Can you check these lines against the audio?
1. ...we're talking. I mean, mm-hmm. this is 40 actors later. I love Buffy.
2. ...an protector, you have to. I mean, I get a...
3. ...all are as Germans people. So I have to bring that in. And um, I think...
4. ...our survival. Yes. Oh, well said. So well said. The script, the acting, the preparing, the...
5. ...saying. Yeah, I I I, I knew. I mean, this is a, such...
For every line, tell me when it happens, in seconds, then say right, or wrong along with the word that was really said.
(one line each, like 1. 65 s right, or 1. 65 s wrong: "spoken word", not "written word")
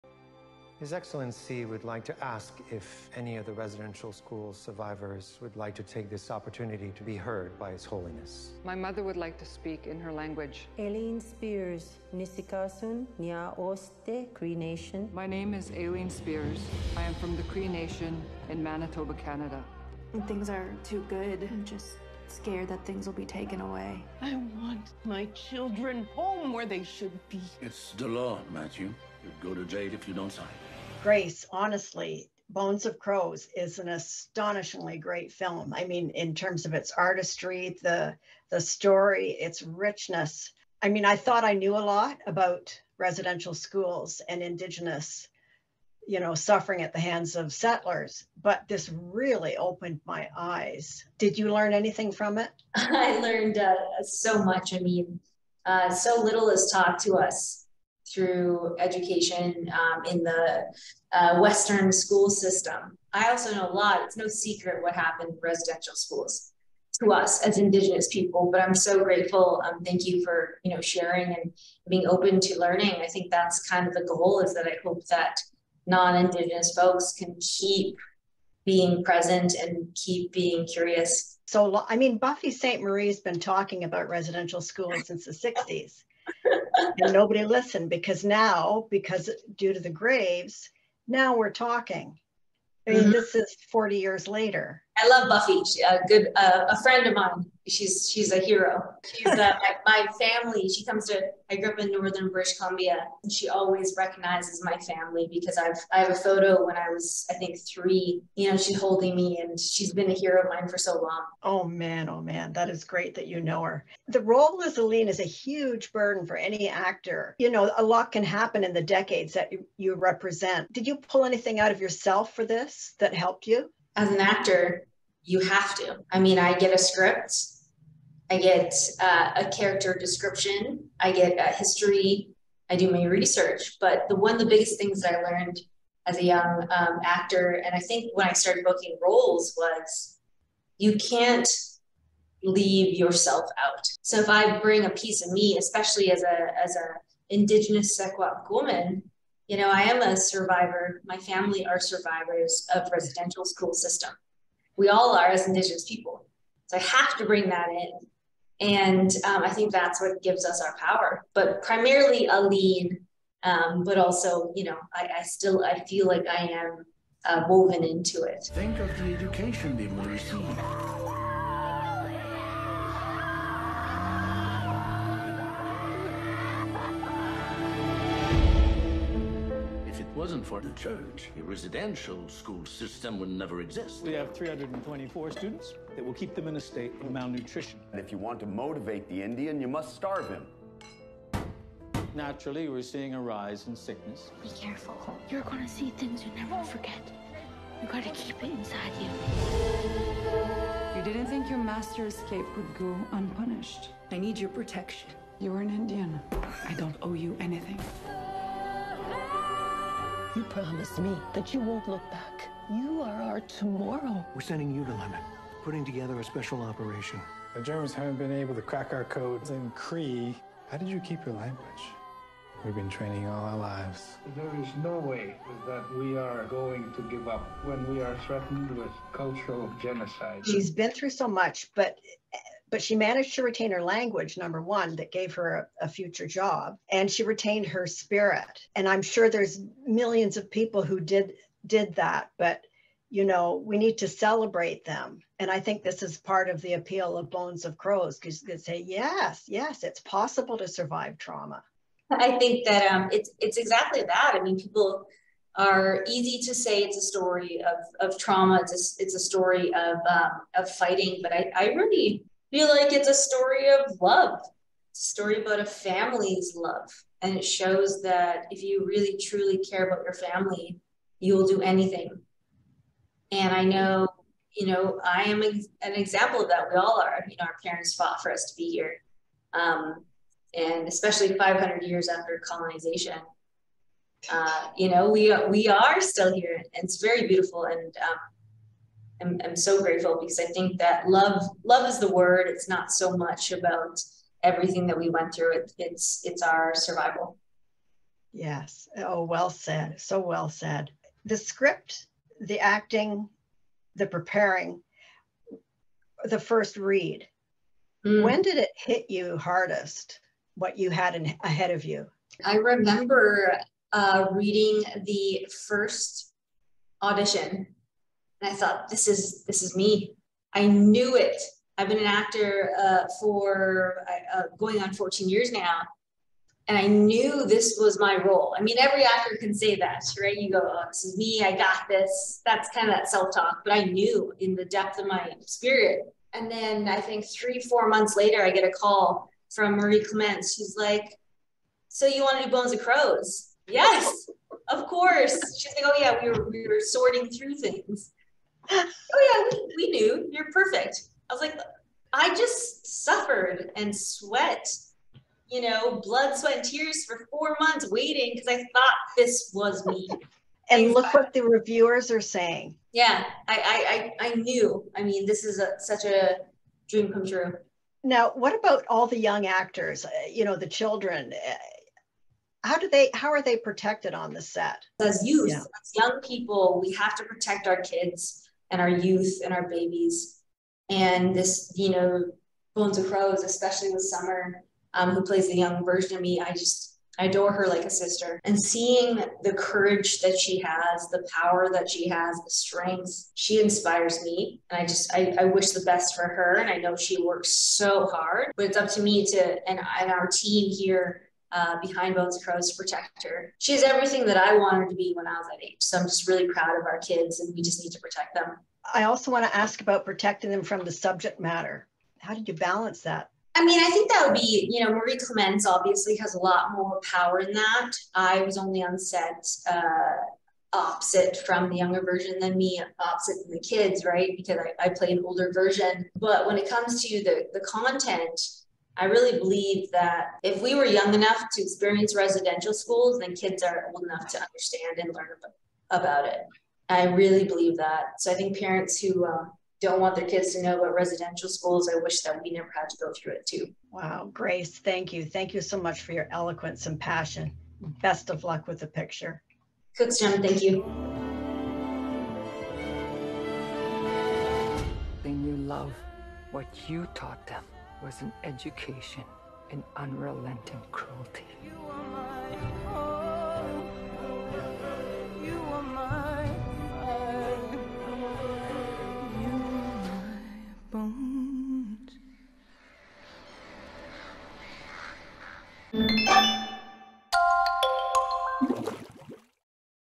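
1. 91 s wrong: "years", not "actors"
2. 124 s wrong: "actor", not "protector"
3. 154 s wrong: "Indigenous", not "Germans"
4. 296 s right
5. 362 s right.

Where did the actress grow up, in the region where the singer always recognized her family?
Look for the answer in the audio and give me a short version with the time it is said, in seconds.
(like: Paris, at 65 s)
northern British Columbia, at 101 s.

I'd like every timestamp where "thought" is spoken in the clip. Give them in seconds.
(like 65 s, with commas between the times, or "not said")
41 s, 318 s, 358 s.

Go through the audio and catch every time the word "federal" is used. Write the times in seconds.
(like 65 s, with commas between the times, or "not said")
not said.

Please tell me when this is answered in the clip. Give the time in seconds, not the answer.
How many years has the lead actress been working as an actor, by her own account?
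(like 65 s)
324 s.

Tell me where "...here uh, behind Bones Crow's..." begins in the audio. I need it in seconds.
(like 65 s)
400 s.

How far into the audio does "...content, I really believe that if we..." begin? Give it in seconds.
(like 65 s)
427 s.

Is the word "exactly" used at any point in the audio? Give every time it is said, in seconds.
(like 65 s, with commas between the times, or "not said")
253 s.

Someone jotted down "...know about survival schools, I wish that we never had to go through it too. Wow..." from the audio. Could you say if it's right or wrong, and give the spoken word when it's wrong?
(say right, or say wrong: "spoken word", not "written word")
wrong: "residential", not "survival".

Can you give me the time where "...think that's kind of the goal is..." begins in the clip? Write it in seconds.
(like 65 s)
73 s.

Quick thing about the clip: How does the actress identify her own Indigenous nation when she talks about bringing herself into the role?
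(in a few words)
Sequat.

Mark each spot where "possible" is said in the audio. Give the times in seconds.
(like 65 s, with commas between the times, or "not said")
249 s.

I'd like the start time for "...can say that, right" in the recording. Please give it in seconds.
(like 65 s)
329 s.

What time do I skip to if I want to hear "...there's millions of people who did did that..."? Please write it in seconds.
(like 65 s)
239 s.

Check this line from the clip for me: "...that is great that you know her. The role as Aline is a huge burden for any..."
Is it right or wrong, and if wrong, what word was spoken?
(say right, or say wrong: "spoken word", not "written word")
right.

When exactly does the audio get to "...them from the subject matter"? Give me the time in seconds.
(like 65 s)
410 s.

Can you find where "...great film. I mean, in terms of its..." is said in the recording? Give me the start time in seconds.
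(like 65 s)
34 s.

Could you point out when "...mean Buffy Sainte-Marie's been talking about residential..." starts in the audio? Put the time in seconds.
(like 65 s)
81 s.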